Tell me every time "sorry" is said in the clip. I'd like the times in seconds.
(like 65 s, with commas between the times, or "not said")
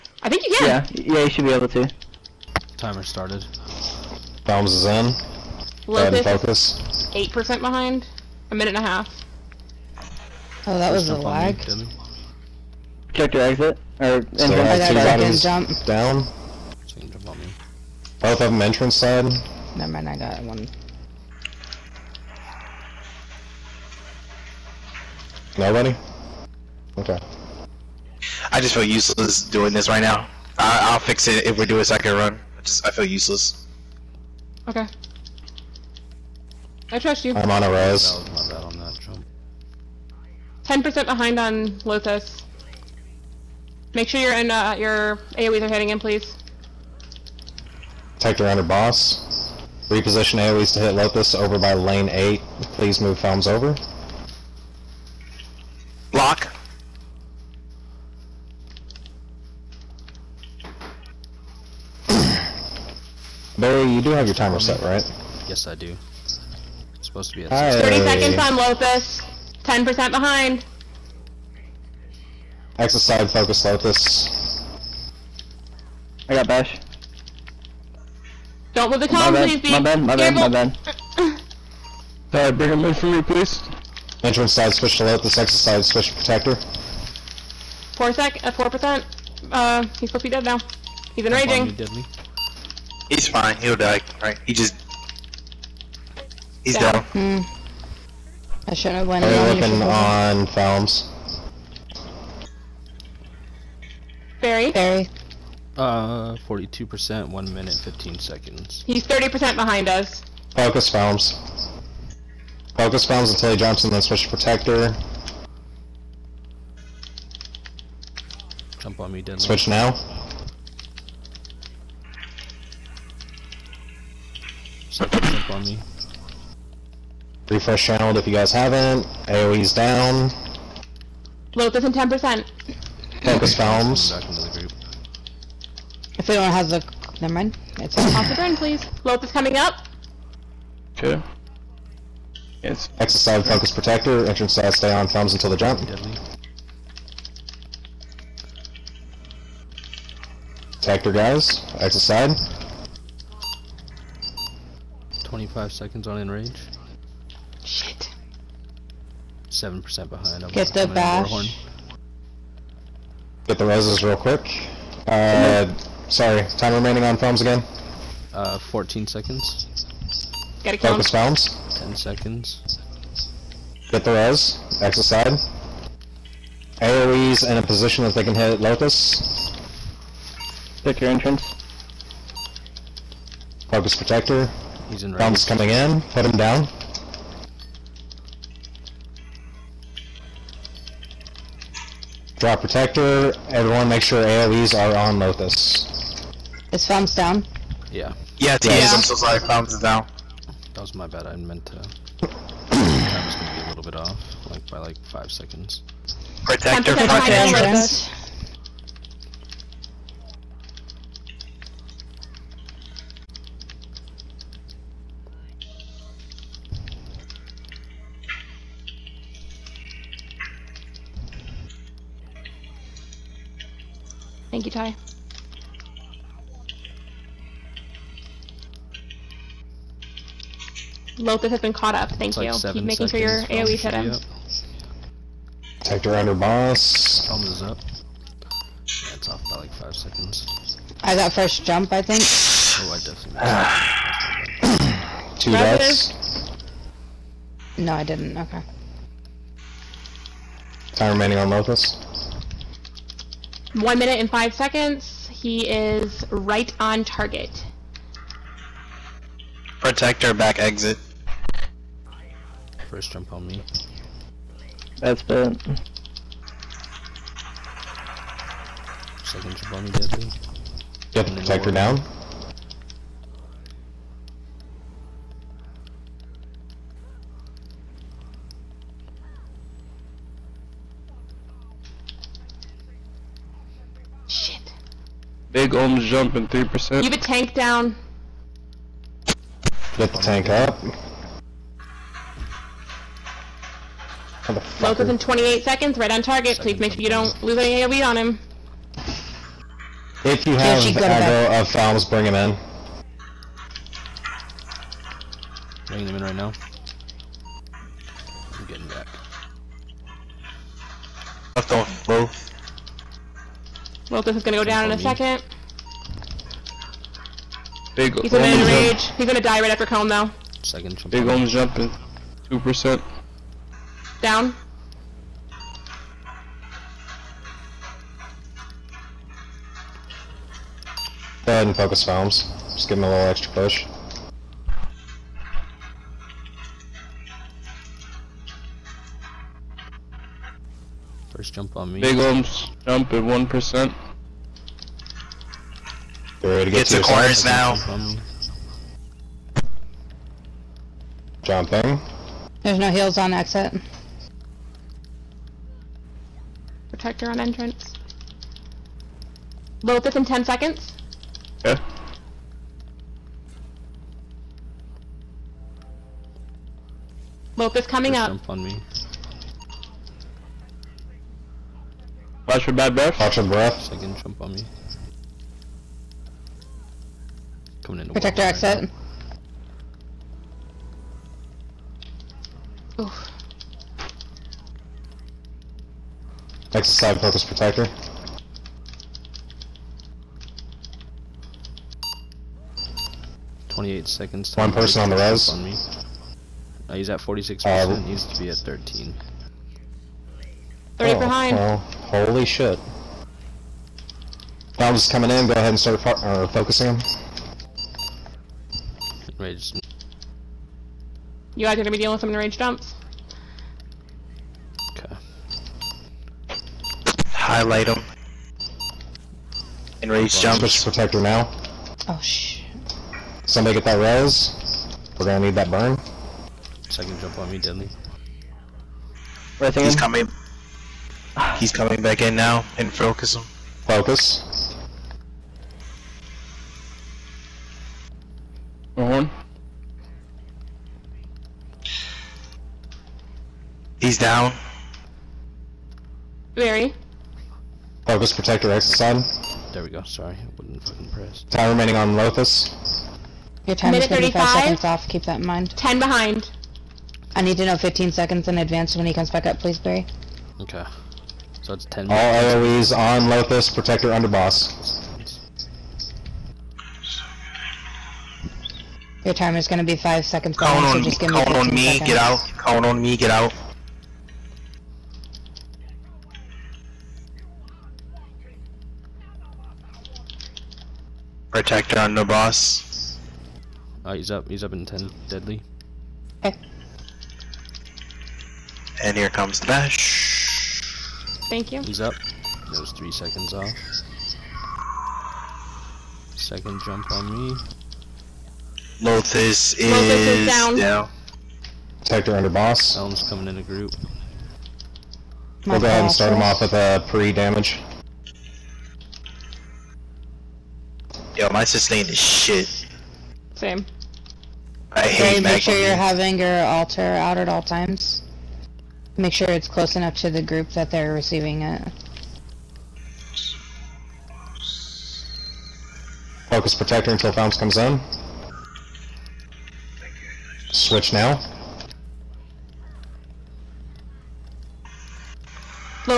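82 s, 166 s, 199 s, 450 s.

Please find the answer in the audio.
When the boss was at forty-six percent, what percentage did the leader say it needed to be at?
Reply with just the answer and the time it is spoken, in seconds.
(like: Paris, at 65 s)
13%, at 398 s.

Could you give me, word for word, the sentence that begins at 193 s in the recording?
Everyone make sure AoEs are on Lotus.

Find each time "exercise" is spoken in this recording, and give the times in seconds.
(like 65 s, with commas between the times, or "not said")
386 s, 448 s.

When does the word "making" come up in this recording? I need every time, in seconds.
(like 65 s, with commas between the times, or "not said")
232 s.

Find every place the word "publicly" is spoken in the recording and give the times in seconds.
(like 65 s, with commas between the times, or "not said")
not said.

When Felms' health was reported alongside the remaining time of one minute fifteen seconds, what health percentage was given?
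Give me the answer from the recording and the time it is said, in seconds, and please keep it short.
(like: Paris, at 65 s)
42%, at 106 s.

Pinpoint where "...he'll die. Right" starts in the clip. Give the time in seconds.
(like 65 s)
93 s.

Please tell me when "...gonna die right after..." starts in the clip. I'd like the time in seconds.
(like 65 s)
319 s.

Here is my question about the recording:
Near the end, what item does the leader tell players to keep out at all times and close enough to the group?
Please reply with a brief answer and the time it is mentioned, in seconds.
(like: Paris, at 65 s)
altar, at 516 s.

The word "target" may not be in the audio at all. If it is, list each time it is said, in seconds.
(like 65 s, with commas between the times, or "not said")
257 s, 296 s.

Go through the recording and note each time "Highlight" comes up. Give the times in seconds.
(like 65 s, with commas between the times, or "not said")
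417 s.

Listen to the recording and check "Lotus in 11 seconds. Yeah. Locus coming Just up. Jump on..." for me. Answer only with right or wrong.
wrong.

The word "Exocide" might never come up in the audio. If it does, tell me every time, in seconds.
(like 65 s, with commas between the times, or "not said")
72 s, 85 s.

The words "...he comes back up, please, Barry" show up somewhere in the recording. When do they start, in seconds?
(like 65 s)
459 s.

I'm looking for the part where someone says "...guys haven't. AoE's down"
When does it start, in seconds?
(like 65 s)
128 s.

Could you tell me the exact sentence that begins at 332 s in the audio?
Just give him a little extra push.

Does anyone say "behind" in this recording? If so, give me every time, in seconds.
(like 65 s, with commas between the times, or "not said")
7 s, 41 s, 70 s, 109 s, 160 s, 401 s, 455 s, 470 s.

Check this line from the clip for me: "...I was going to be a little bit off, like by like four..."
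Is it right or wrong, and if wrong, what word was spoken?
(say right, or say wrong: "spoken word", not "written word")
wrong: "five", not "four".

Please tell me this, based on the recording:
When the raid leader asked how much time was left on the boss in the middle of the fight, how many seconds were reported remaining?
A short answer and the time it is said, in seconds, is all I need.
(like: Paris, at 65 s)
14 seconds, at 168 s.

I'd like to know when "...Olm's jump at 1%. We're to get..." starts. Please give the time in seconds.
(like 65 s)
342 s.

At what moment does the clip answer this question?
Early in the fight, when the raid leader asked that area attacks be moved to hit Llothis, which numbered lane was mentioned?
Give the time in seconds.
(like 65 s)
51 s.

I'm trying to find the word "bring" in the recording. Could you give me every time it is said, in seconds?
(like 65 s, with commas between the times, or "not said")
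82 s, 302 s.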